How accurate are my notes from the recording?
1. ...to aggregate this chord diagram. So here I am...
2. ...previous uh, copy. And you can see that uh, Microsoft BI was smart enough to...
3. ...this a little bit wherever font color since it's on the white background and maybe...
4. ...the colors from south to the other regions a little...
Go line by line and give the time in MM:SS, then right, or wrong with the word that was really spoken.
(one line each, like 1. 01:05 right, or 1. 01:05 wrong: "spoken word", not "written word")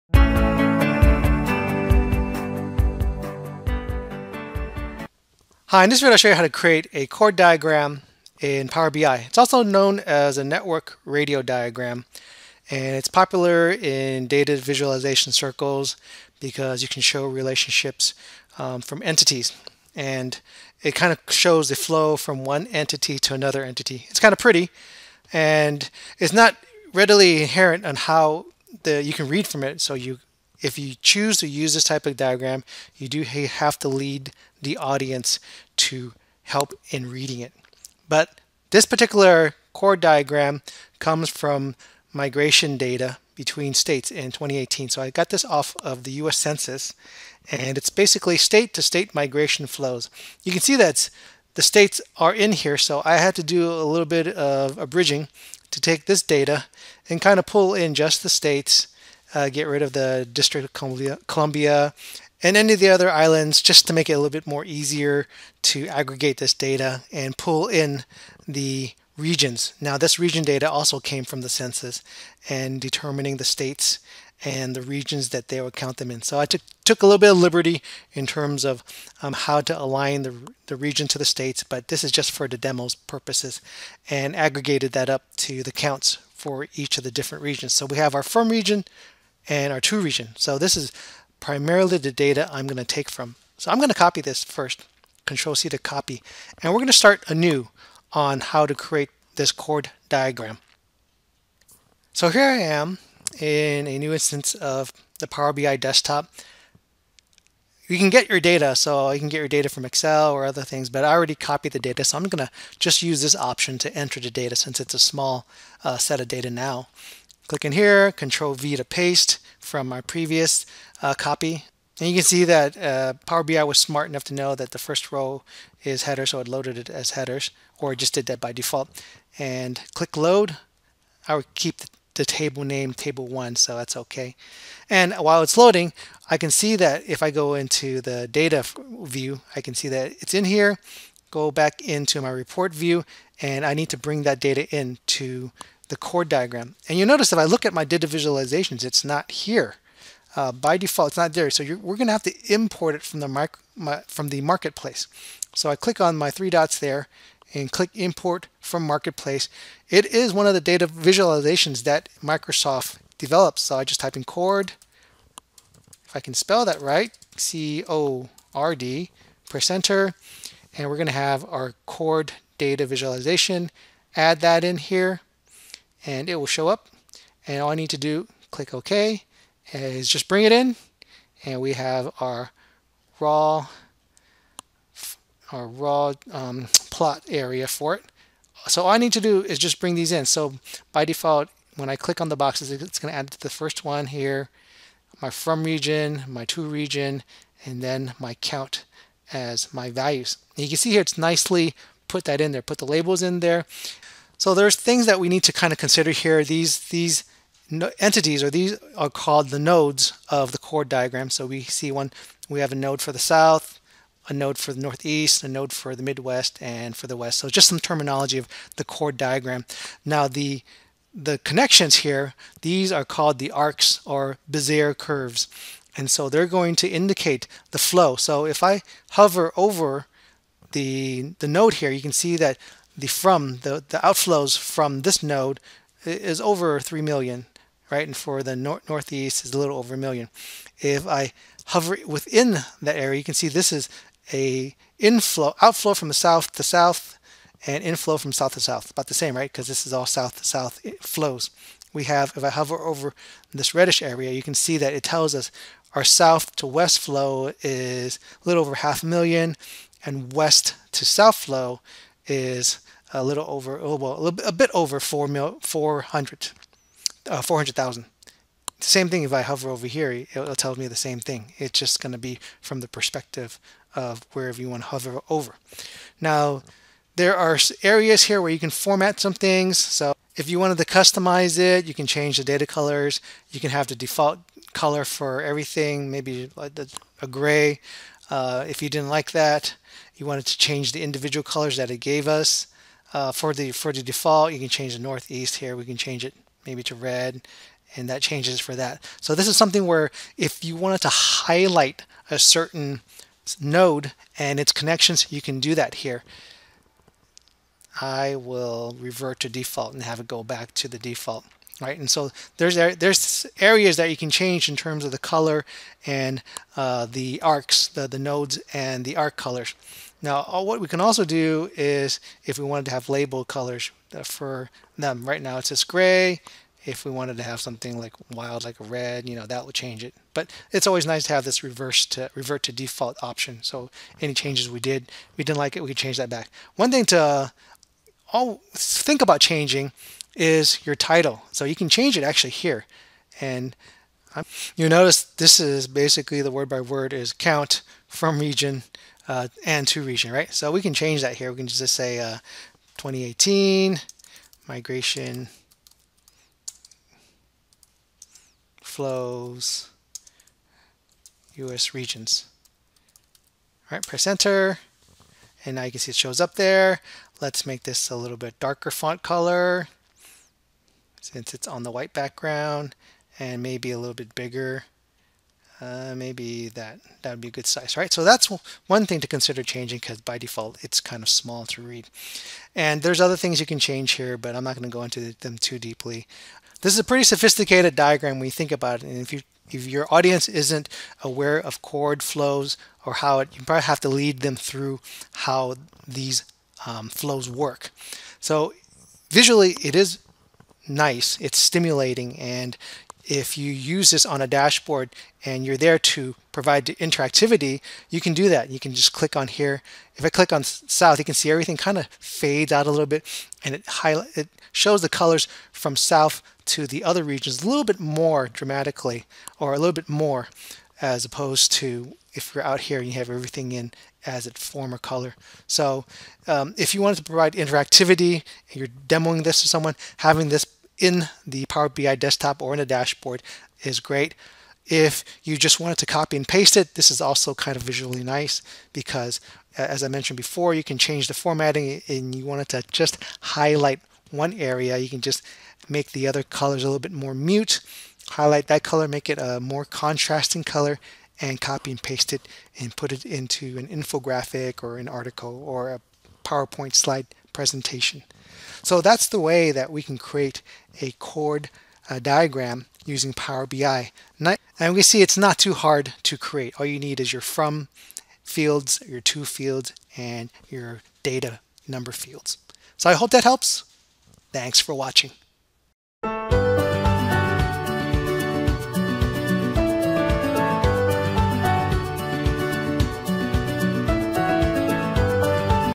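1. 01:38 wrong: "create", not "aggregate"
2. 01:59 wrong: "Power", not "Microsoft"
3. 06:07 wrong: "darker", not "wherever"
4. 06:55 right.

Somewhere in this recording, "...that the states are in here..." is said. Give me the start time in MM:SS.
00:50.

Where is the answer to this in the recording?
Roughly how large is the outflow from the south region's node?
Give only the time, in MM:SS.
03:56.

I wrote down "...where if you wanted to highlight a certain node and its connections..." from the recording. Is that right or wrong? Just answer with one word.
right.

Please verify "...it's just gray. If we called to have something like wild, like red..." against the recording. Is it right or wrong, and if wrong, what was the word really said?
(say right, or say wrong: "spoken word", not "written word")
wrong: "wanted", not "called".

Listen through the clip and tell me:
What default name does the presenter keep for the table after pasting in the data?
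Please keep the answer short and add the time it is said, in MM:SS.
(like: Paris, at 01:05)
table one, at 02:12.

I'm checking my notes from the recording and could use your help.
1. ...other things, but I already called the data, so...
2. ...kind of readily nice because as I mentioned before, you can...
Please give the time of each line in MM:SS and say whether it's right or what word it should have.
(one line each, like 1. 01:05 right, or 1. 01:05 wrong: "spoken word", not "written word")
1. 01:50 wrong: "copied", not "called"
2. 07:17 wrong: "visually", not "readily".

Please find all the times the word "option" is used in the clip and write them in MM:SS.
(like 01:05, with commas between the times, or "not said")
01:53, 05:33.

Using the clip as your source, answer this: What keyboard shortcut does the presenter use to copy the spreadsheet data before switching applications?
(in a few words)
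Control C.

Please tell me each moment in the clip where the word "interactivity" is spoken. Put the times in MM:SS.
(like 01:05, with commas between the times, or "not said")
06:46, 07:07.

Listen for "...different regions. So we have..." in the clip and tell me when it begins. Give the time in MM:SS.
01:27.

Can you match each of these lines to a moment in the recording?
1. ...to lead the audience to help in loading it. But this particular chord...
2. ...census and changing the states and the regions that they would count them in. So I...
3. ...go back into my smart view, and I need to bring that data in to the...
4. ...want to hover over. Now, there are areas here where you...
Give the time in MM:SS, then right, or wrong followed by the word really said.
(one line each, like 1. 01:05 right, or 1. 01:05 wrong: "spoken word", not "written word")
1. 00:33 wrong: "reading", not "loading"
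2. 01:11 wrong: "determining", not "changing"
3. 02:21 wrong: "report", not "smart"
4. 04:34 right.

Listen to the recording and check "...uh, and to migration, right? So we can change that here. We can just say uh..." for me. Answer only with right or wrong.
wrong.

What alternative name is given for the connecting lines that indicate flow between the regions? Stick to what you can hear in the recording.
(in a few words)
Bezier curves.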